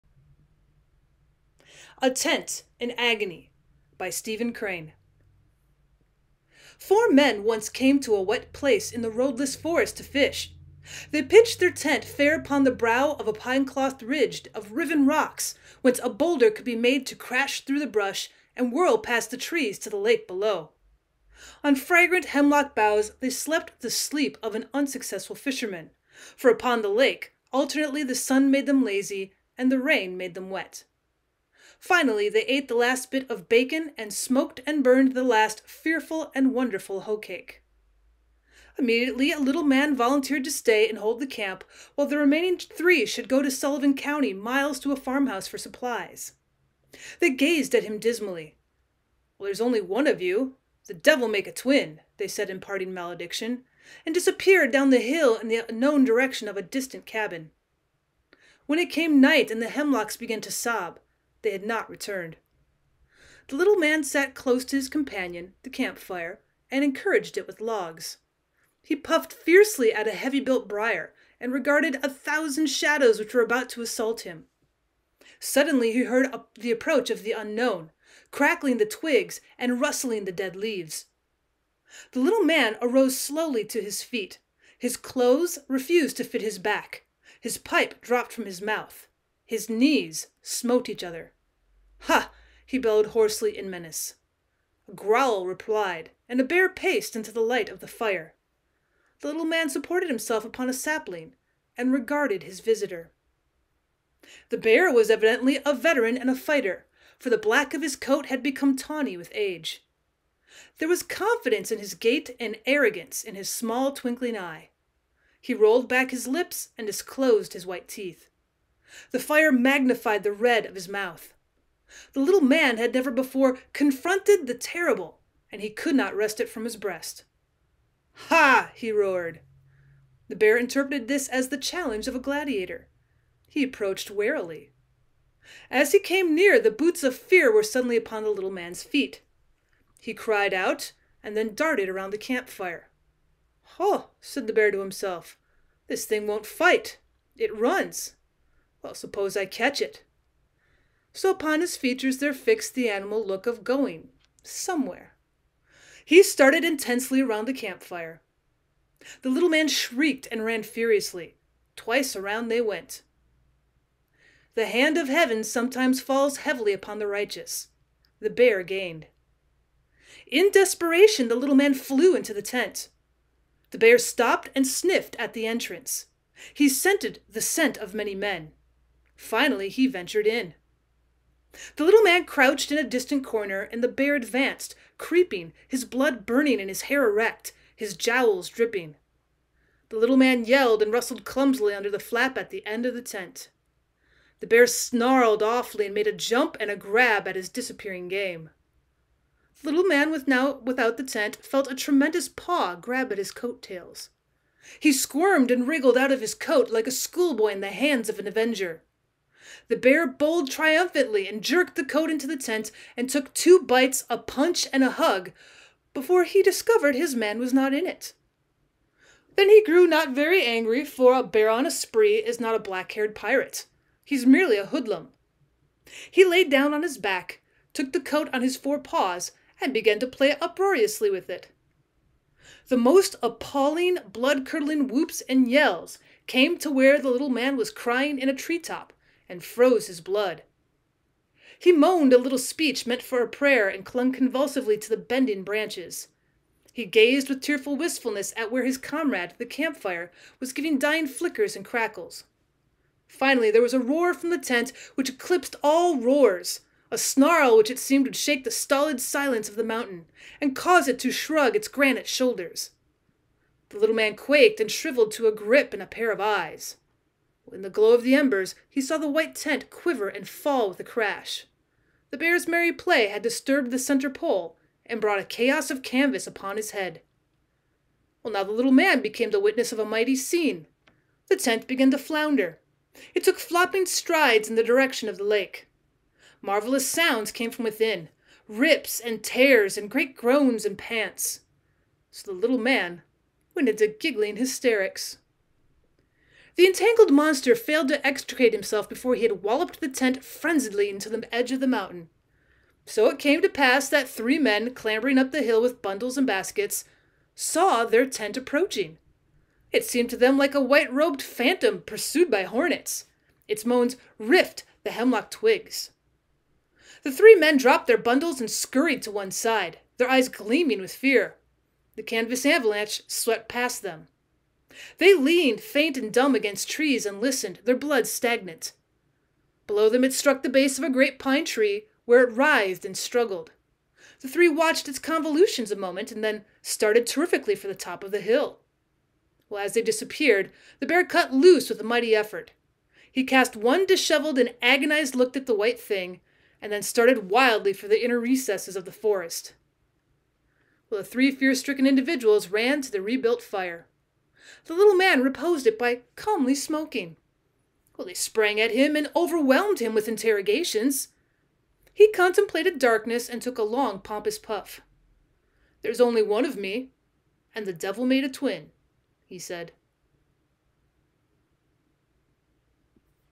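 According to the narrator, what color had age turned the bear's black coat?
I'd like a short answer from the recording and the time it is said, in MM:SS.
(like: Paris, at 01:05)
Tawny, at 01:48.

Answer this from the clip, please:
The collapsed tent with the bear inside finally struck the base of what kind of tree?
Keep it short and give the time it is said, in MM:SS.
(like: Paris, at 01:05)
Pine tree, at 05:31.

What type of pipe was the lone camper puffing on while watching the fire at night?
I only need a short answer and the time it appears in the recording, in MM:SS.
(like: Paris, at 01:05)
Briar, at 01:10.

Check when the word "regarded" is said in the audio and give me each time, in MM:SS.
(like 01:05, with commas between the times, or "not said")
01:11, 01:41.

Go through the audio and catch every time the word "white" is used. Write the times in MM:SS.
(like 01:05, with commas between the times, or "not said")
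01:57, 04:29, 05:10, 05:45.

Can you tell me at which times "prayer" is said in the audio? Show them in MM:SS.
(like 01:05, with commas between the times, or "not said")
04:03.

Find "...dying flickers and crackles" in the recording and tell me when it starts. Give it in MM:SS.
04:10.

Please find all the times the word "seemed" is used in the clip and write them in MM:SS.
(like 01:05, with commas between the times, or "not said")
04:17, 05:09.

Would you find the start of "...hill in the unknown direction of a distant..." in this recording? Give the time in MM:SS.
00:54.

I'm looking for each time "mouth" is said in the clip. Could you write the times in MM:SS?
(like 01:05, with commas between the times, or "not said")
01:28, 02:00.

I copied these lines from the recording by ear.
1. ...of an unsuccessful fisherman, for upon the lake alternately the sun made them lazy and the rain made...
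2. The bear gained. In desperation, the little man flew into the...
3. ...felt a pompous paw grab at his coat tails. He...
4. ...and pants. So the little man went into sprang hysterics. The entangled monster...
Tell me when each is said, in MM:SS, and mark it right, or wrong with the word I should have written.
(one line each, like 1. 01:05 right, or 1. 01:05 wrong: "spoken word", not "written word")
1. 00:24 right
2. 02:48 right
3. 03:21 wrong: "tremendous", not "pompous"
4. 04:50 wrong: "giggling", not "sprang".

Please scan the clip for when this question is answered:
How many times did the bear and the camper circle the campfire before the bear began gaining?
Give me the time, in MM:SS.
02:41.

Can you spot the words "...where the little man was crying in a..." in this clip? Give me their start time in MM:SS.
03:56.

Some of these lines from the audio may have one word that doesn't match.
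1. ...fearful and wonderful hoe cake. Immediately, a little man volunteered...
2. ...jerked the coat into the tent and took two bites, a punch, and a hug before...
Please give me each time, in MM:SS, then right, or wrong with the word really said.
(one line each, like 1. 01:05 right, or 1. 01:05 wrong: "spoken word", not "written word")
1. 00:35 right
2. 03:31 right.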